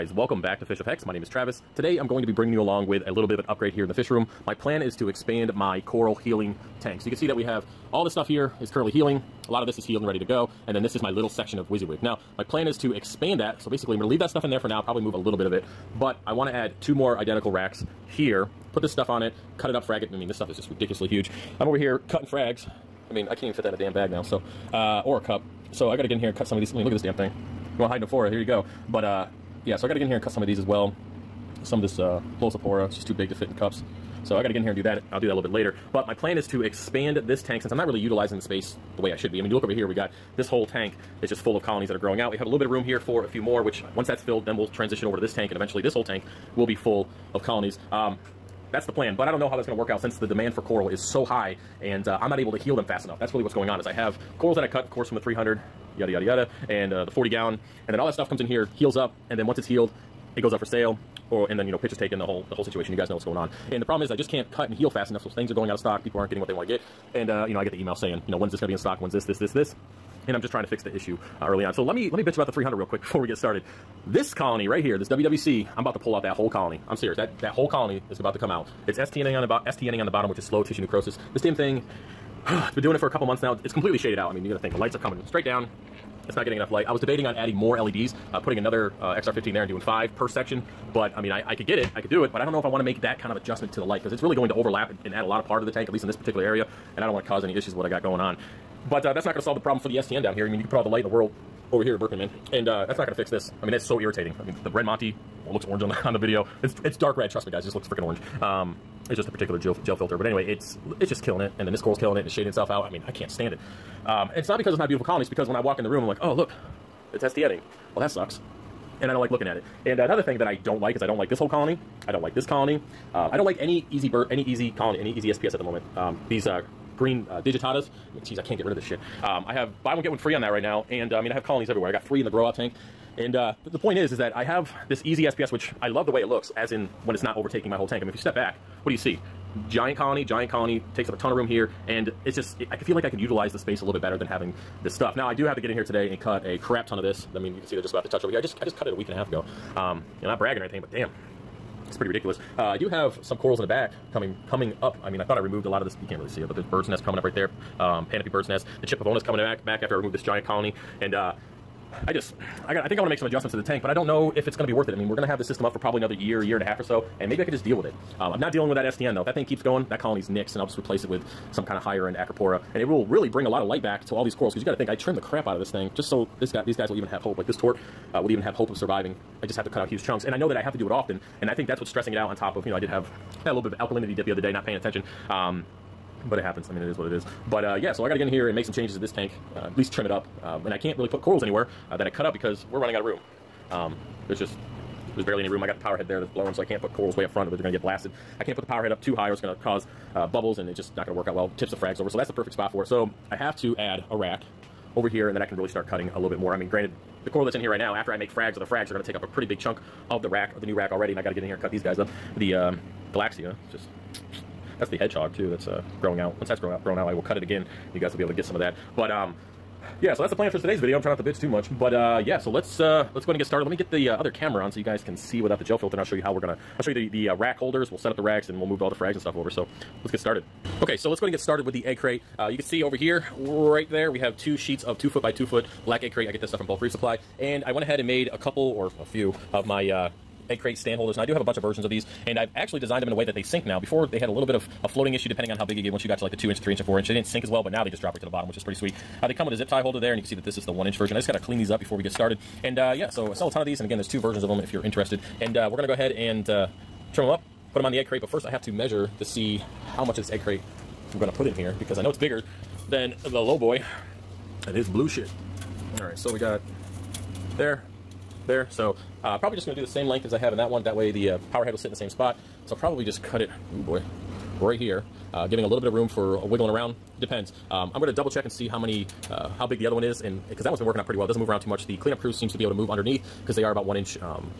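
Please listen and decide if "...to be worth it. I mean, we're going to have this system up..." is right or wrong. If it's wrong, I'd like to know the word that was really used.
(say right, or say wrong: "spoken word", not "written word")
right.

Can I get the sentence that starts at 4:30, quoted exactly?
That way the uh, power head will sit in the same spot.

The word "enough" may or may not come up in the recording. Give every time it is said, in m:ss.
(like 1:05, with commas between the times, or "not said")
0:53, 1:05, 1:26.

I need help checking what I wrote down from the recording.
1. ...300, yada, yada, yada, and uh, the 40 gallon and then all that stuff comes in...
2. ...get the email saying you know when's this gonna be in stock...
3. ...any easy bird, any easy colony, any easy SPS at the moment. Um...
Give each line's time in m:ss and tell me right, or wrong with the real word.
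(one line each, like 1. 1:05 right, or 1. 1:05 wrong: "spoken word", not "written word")
1. 0:55 right
2. 1:07 right
3. 2:03 right.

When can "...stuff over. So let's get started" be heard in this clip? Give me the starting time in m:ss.
3:49.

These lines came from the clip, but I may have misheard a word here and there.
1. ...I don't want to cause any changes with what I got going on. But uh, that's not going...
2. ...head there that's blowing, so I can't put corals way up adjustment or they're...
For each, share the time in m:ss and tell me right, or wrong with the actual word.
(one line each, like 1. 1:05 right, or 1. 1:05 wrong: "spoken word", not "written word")
1. 1:37 wrong: "issues", not "changes"
2. 3:15 wrong: "front", not "adjustment".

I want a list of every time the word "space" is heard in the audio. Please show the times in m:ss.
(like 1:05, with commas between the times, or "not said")
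0:38, 2:23.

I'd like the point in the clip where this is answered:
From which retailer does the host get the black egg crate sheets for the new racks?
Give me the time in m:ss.
3:56.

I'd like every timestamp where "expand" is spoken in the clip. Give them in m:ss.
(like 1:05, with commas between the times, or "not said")
0:05, 0:12, 0:36.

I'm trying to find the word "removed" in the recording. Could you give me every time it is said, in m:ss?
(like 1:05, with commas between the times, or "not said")
2:35, 2:39.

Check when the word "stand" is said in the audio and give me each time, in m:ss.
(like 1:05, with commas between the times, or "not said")
1:53, 4:00.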